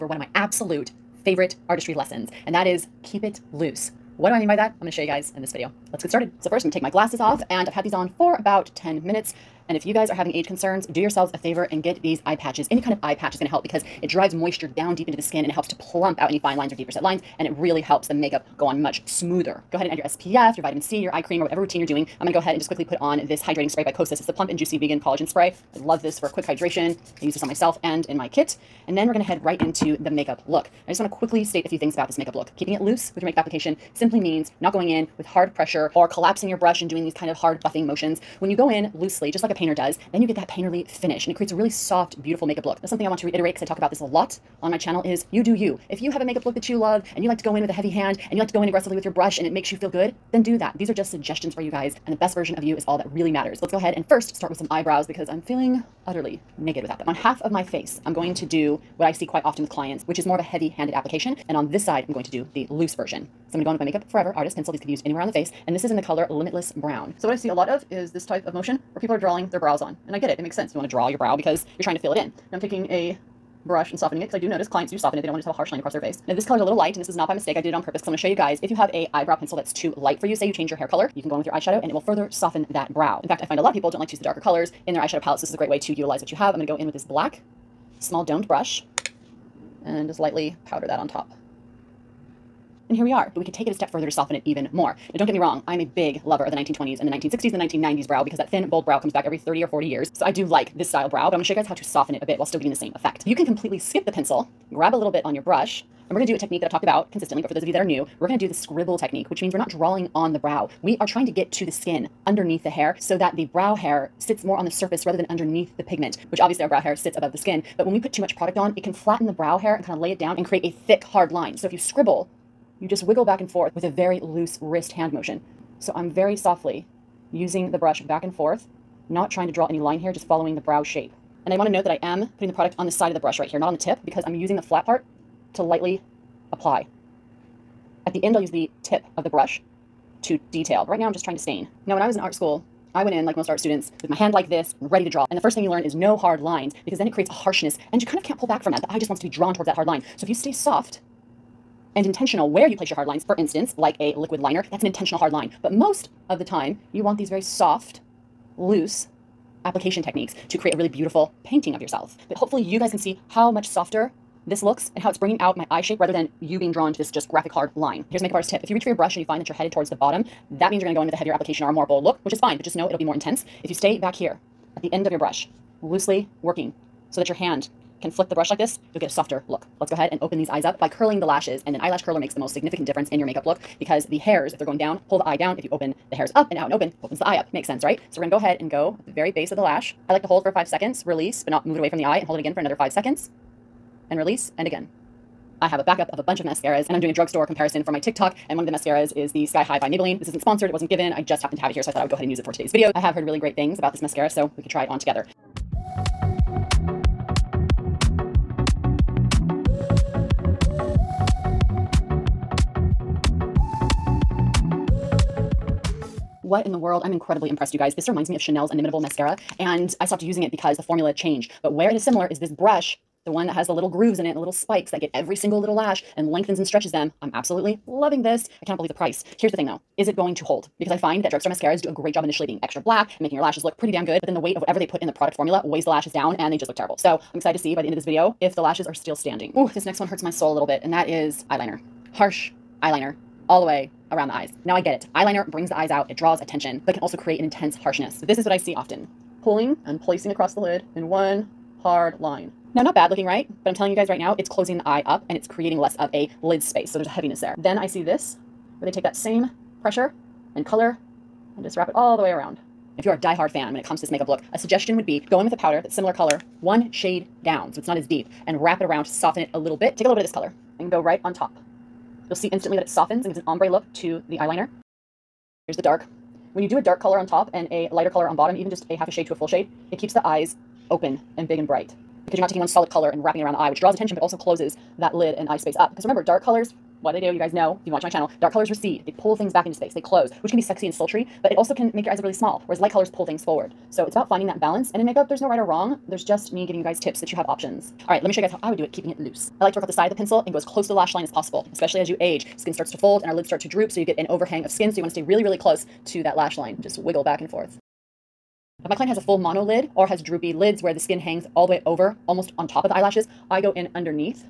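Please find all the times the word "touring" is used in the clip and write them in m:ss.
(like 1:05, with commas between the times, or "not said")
not said.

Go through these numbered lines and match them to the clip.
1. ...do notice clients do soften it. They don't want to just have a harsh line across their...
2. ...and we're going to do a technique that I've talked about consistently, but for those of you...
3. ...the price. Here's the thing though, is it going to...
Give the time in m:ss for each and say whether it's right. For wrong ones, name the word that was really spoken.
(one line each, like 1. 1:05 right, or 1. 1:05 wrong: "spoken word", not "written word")
1. 1:14 right
2. 1:46 right
3. 3:48 right.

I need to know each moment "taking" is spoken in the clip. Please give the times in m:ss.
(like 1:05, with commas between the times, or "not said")
1:12, 4:42.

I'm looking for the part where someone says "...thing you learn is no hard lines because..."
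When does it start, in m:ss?
2:25.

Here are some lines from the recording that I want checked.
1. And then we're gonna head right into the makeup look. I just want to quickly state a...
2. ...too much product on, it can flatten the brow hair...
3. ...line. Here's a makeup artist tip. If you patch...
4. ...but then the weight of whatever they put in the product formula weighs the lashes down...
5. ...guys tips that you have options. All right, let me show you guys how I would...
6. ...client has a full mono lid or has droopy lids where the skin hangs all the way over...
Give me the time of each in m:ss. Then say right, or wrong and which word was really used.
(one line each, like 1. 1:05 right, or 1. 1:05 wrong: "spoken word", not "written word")
1. 0:28 right
2. 1:58 right
3. 2:47 wrong: "reach", not "patch"
4. 3:54 right
5. 4:56 right
6. 5:08 right.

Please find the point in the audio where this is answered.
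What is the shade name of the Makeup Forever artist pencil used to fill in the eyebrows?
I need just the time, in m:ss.
1:06.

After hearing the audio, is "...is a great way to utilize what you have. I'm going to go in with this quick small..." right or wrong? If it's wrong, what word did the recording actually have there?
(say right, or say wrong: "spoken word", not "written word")
wrong: "black", not "quick".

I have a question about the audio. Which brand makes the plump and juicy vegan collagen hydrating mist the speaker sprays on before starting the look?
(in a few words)
Kosas.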